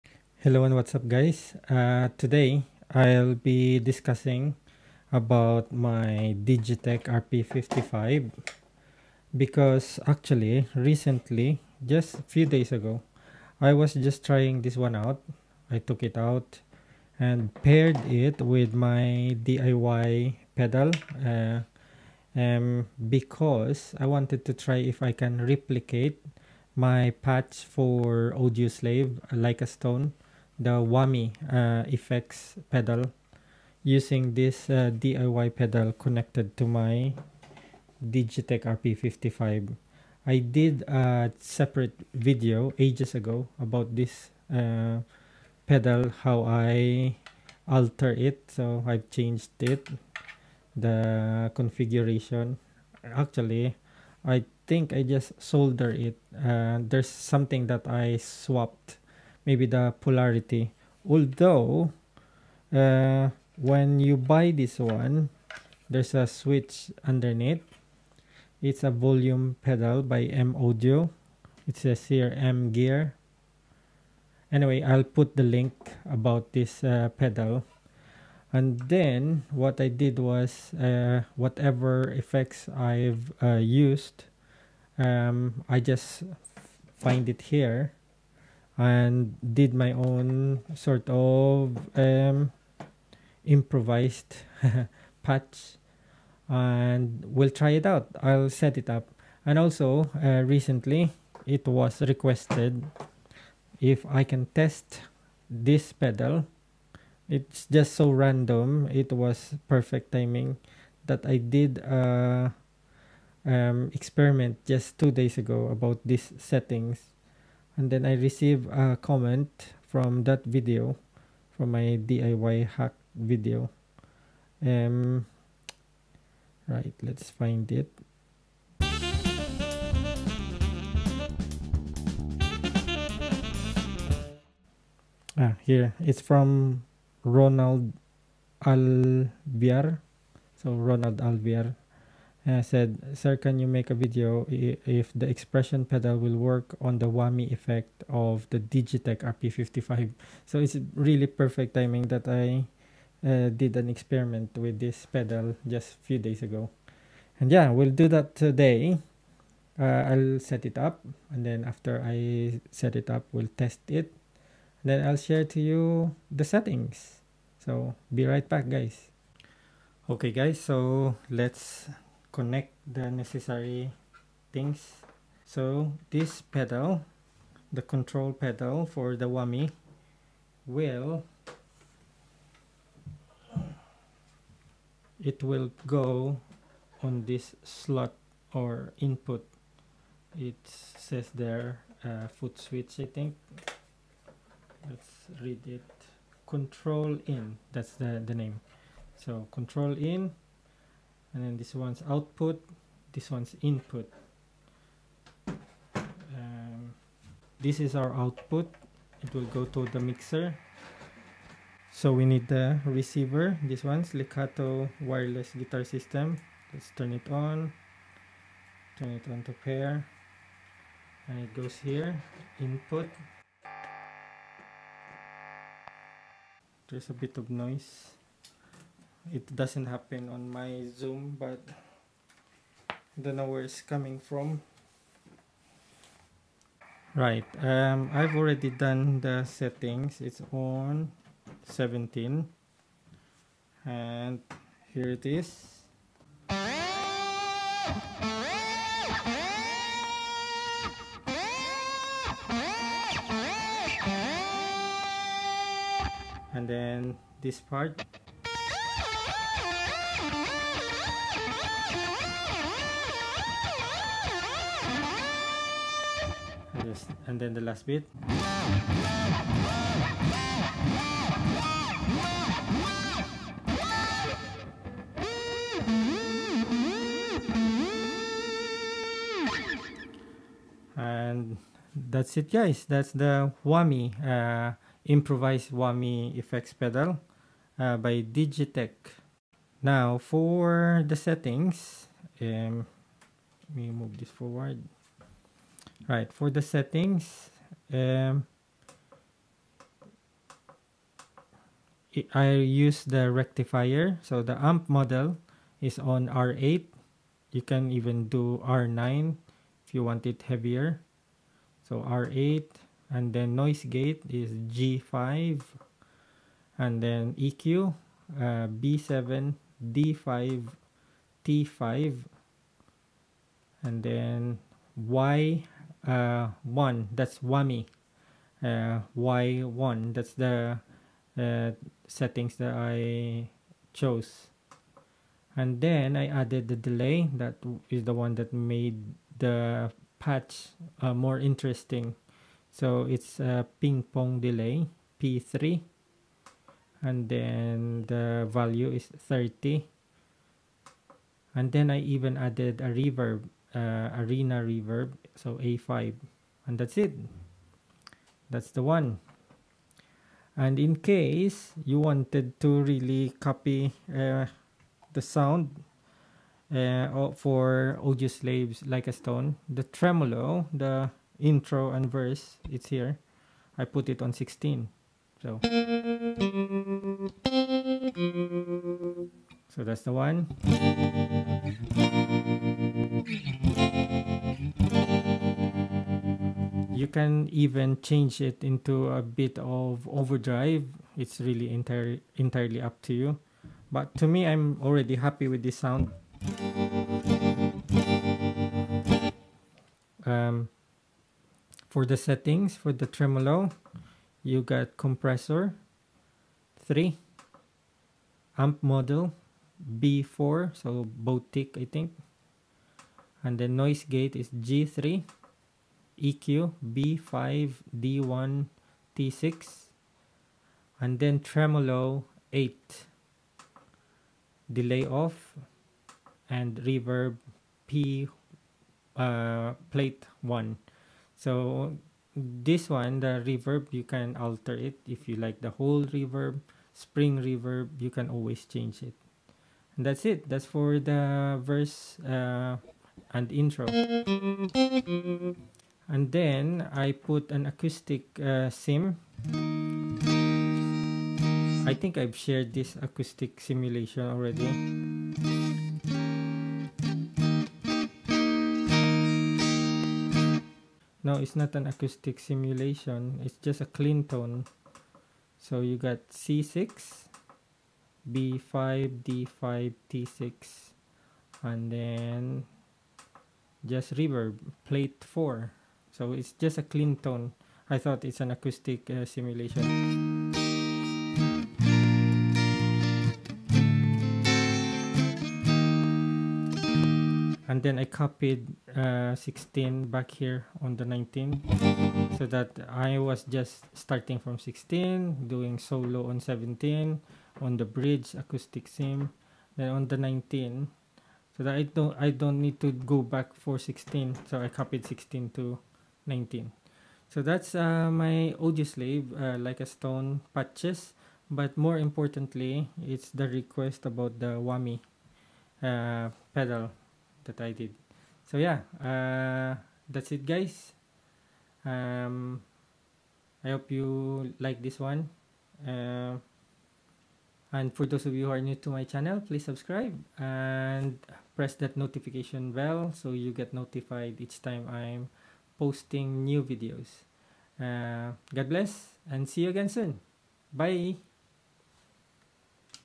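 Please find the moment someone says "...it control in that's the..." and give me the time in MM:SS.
03:15.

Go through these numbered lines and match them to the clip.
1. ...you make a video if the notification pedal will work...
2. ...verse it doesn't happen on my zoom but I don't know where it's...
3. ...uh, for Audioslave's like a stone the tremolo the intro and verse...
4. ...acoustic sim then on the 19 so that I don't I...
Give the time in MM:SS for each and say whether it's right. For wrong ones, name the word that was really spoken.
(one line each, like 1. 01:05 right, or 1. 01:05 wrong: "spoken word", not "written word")
1. 02:23 wrong: "expression", not "notification"
2. 03:47 wrong: "noise", not "verse"
3. 06:06 right
4. 08:18 right.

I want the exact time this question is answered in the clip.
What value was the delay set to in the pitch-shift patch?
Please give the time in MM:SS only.
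05:49.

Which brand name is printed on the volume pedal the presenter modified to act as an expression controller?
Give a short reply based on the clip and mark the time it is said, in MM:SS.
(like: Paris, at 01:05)
M Gear, at 01:12.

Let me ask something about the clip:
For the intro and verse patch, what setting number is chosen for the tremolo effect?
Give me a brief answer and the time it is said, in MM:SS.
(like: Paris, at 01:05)
8, at 07:01.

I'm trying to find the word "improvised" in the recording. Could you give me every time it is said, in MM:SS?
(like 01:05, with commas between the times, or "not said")
01:33, 04:45.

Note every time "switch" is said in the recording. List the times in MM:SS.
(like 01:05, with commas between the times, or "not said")
01:06, 03:12.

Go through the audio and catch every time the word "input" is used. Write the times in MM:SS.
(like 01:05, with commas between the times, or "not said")
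03:08, 03:23, 03:42.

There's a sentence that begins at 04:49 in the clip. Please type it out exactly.
Now for the settings, um, let me move this forward.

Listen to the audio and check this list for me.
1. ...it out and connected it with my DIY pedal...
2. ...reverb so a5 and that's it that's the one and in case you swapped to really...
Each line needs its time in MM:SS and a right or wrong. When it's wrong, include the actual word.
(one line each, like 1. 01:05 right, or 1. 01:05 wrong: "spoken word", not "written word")
1. 00:16 wrong: "paired", not "connected"
2. 05:54 wrong: "wanted", not "swapped".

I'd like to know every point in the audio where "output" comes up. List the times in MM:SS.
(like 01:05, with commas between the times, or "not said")
03:22, 03:28.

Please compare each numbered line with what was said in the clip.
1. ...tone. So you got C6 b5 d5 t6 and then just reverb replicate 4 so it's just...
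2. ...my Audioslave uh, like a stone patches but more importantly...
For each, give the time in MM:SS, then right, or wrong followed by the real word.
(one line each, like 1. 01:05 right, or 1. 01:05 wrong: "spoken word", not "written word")
1. 07:44 wrong: "plate", not "replicate"
2. 08:28 right.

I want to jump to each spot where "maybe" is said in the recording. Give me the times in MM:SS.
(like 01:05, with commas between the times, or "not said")
00:59.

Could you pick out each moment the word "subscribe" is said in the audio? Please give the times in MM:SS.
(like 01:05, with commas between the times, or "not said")
08:49.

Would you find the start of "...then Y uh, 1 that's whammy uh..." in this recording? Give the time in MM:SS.
05:24.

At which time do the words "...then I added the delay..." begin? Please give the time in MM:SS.
05:35.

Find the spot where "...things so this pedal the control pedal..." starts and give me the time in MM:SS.
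02:54.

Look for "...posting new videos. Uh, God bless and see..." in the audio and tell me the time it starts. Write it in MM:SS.
08:55.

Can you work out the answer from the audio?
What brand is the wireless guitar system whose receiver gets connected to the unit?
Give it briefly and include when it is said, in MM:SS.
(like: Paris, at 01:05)
Lekato, at 03:34.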